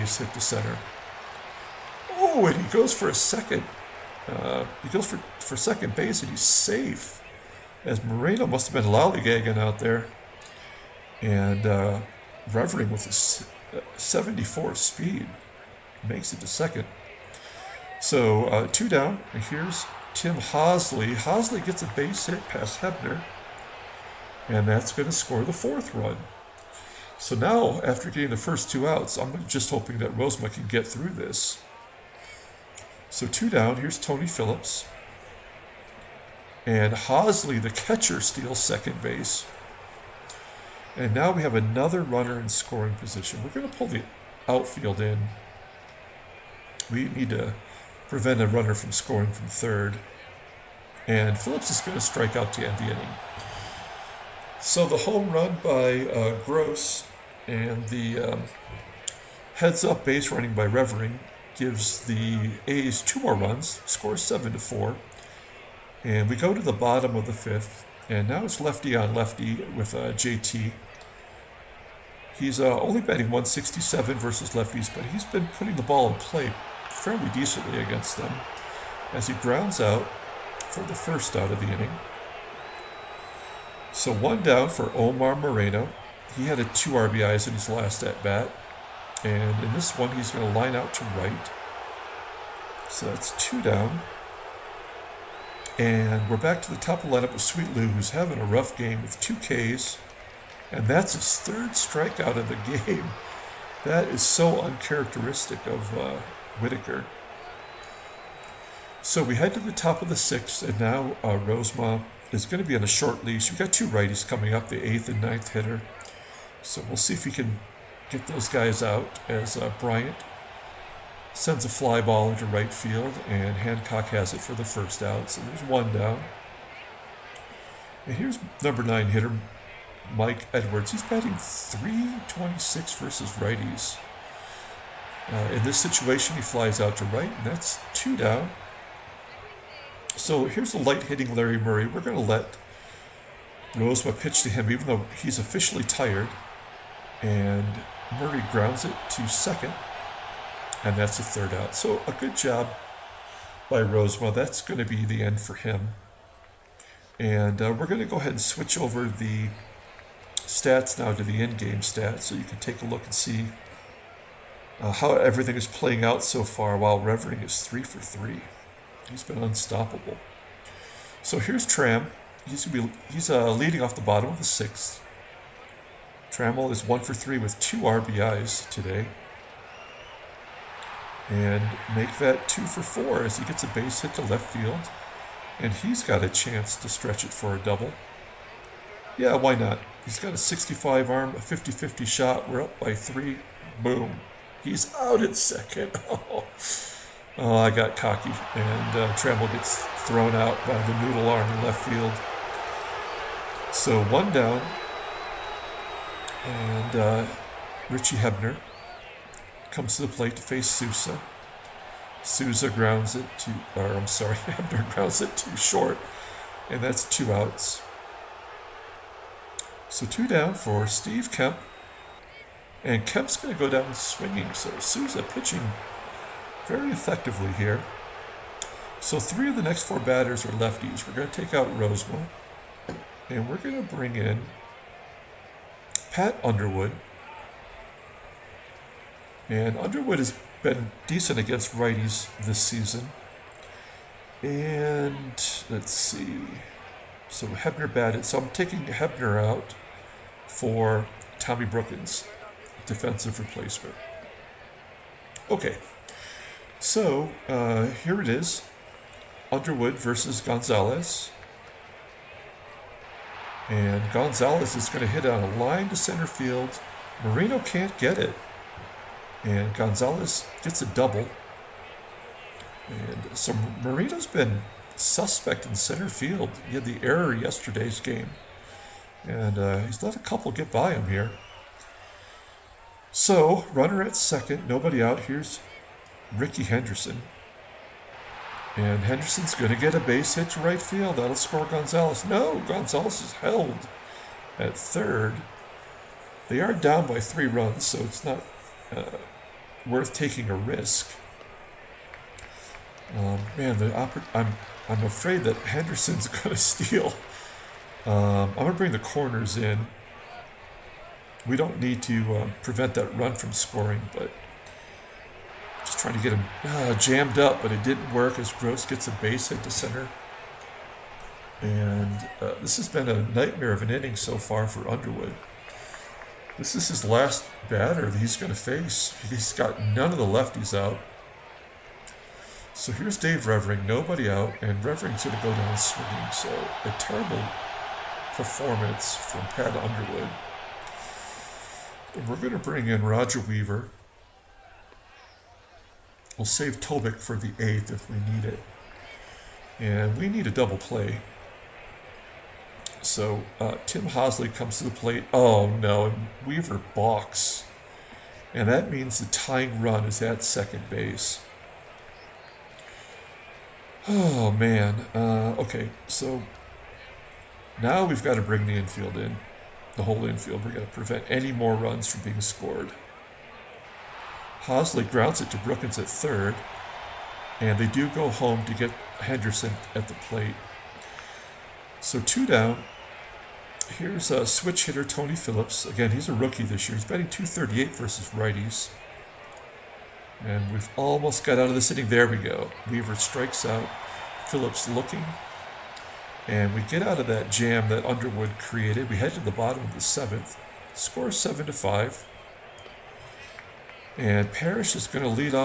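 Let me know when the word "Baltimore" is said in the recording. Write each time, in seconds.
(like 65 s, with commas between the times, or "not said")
not said.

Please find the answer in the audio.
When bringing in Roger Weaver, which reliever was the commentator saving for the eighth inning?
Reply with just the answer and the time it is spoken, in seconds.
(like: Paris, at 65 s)
Tobik, at 346 s.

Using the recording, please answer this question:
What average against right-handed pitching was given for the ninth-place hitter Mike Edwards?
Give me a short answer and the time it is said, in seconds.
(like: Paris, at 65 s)
326, at 131 s.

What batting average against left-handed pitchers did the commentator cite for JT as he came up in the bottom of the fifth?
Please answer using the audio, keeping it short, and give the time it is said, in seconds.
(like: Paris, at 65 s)
167, at 73 s.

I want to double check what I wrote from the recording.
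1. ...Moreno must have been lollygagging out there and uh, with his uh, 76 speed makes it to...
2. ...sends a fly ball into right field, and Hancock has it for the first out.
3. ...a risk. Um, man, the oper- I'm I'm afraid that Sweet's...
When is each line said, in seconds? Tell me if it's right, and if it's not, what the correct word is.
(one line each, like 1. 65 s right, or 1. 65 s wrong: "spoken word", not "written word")
1. 8 s wrong: "74", not "76"
2. 121 s right
3. 300 s wrong: "Henderson", not "Sweet".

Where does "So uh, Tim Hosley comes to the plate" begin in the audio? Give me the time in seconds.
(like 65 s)
353 s.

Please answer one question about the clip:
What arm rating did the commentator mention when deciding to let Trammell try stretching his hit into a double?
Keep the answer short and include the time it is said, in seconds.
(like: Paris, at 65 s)
65, at 190 s.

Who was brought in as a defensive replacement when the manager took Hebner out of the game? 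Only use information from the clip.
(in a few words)
Tommy Brookens.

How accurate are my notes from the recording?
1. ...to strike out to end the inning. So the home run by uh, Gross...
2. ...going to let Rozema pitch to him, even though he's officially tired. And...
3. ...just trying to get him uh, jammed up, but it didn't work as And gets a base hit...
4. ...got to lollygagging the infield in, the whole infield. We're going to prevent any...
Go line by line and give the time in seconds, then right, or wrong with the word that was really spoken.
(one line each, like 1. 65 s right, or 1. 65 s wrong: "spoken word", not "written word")
1. 51 s right
2. 142 s right
3. 315 s wrong: "Gross", not "And"
4. 368 s wrong: "bring", not "lollygagging".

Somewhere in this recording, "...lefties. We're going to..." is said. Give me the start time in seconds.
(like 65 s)
230 s.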